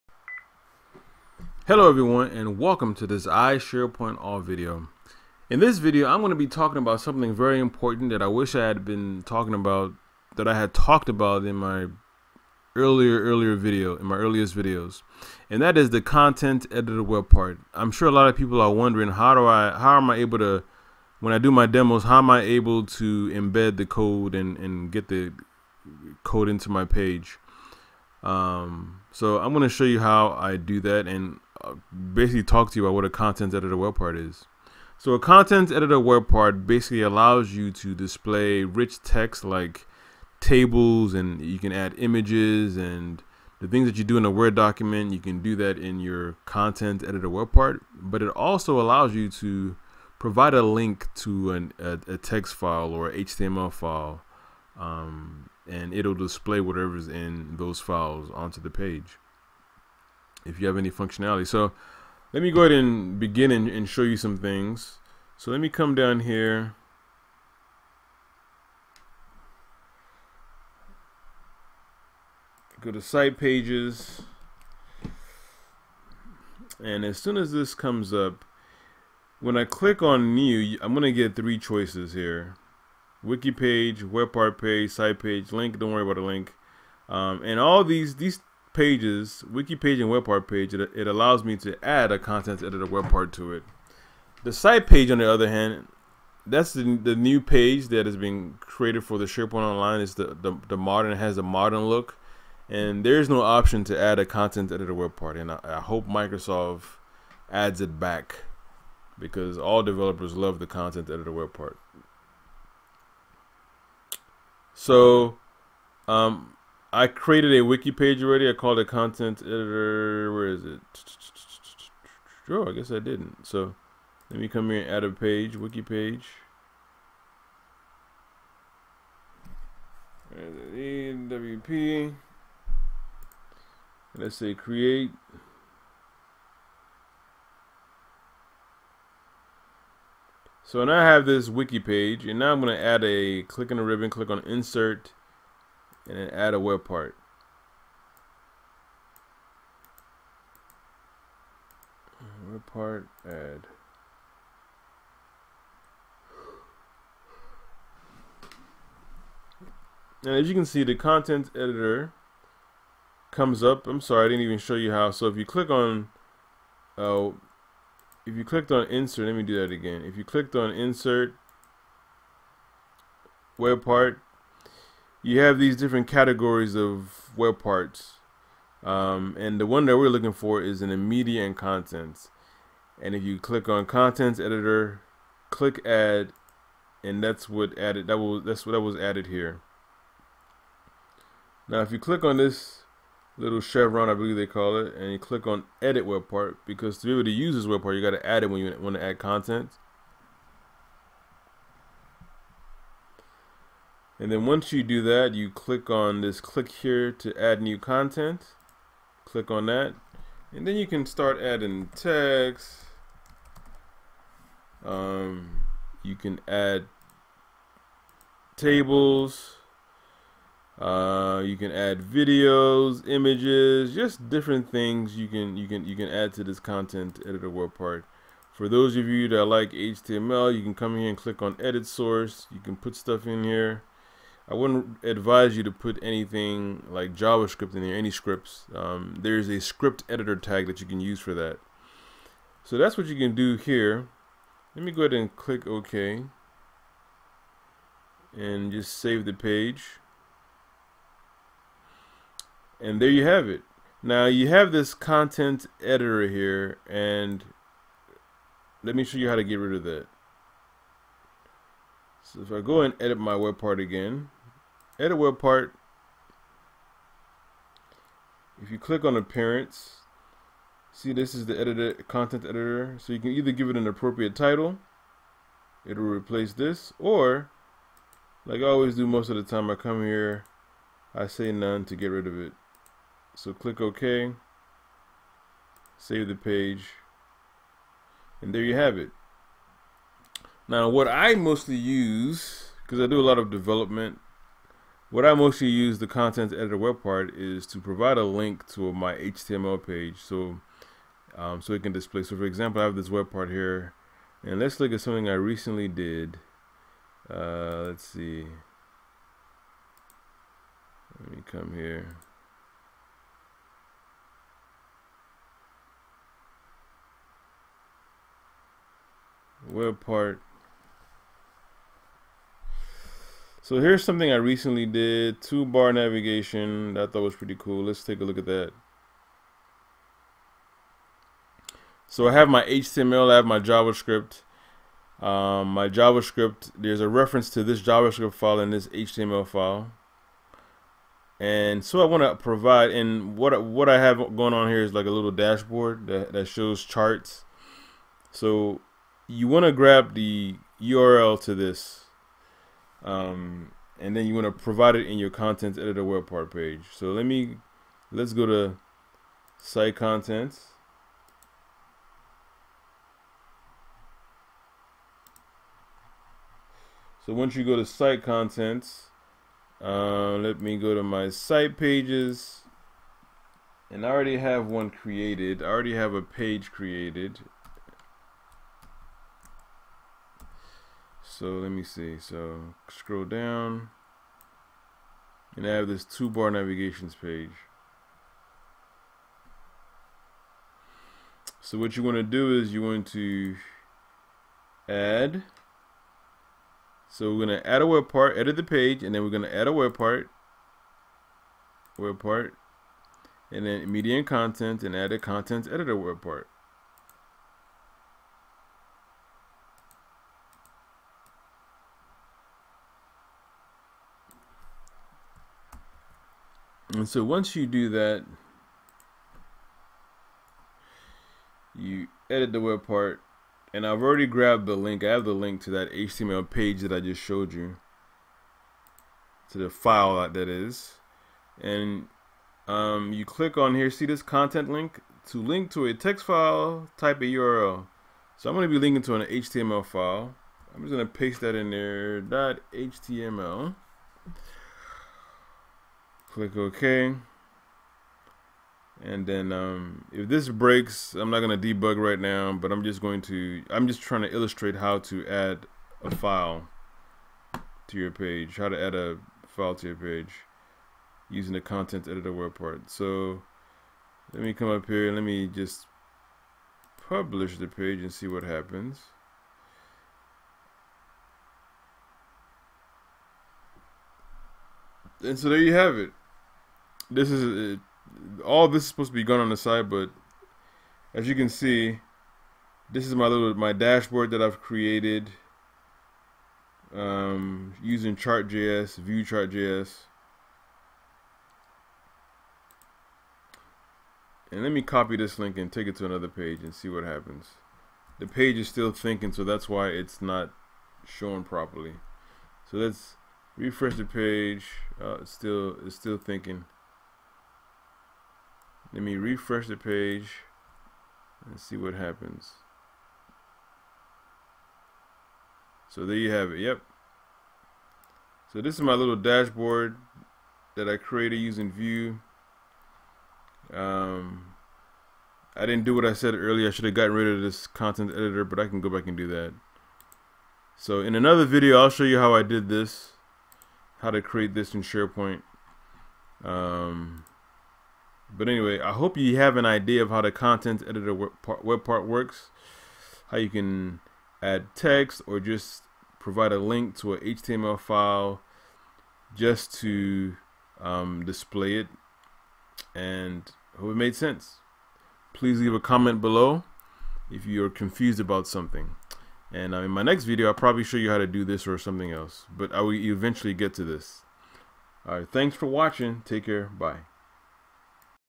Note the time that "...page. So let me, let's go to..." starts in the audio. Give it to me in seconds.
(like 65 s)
356 s.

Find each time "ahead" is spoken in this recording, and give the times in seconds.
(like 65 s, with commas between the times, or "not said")
62 s, 245 s.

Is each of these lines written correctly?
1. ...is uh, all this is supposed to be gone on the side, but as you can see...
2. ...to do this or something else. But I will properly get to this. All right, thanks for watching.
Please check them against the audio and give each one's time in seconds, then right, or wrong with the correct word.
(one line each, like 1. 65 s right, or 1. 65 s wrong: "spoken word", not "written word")
1. 477 s right
2. 561 s wrong: "eventually", not "properly".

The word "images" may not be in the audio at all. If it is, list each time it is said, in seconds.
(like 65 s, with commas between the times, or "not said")
41 s, 223 s.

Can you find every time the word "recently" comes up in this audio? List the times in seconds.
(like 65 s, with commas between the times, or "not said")
305 s, 324 s.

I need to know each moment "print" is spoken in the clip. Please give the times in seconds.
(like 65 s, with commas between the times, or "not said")
not said.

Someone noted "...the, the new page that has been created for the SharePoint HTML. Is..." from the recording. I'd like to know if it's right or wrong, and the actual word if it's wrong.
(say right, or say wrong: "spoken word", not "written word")
wrong: "Online", not "HTML".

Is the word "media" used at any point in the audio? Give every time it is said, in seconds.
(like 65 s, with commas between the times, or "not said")
180 s, 403 s.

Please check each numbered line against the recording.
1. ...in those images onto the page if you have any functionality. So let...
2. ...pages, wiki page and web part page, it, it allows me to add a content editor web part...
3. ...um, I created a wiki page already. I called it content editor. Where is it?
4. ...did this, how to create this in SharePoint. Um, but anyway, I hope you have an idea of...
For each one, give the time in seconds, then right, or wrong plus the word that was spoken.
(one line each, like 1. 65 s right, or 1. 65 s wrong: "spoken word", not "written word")
1. 57 s wrong: "files", not "images"
2. 88 s right
3. 116 s right
4. 532 s right.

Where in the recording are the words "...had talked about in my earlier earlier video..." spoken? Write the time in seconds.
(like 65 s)
10 s.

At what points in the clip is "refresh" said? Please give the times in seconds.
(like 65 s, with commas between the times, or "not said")
503 s, 509 s.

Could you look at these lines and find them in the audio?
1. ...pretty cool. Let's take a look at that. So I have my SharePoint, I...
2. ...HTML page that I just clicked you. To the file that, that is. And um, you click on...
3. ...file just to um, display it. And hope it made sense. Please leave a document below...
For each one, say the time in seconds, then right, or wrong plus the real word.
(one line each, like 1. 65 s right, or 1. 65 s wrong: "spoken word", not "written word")
1. 327 s wrong: "HTML", not "SharePoint"
2. 425 s wrong: "showed", not "clicked"
3. 547 s wrong: "comment", not "document".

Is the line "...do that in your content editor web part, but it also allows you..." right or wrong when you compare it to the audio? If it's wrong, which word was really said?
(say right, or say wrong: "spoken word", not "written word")
right.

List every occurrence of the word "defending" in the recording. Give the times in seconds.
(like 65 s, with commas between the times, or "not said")
not said.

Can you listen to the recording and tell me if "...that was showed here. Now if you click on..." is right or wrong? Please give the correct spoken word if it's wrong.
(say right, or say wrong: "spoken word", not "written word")
wrong: "added", not "showed".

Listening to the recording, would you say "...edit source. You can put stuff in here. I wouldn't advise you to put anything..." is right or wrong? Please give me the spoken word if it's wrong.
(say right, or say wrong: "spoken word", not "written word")
right.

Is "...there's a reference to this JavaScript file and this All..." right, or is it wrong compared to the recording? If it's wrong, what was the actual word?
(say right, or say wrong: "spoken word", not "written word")
wrong: "HTML", not "All".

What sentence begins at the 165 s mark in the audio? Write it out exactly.
So if you click on, oh, if you clicked on insert, let me do that again.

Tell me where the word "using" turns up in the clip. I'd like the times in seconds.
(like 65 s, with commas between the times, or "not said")
461 s, 487 s, 521 s.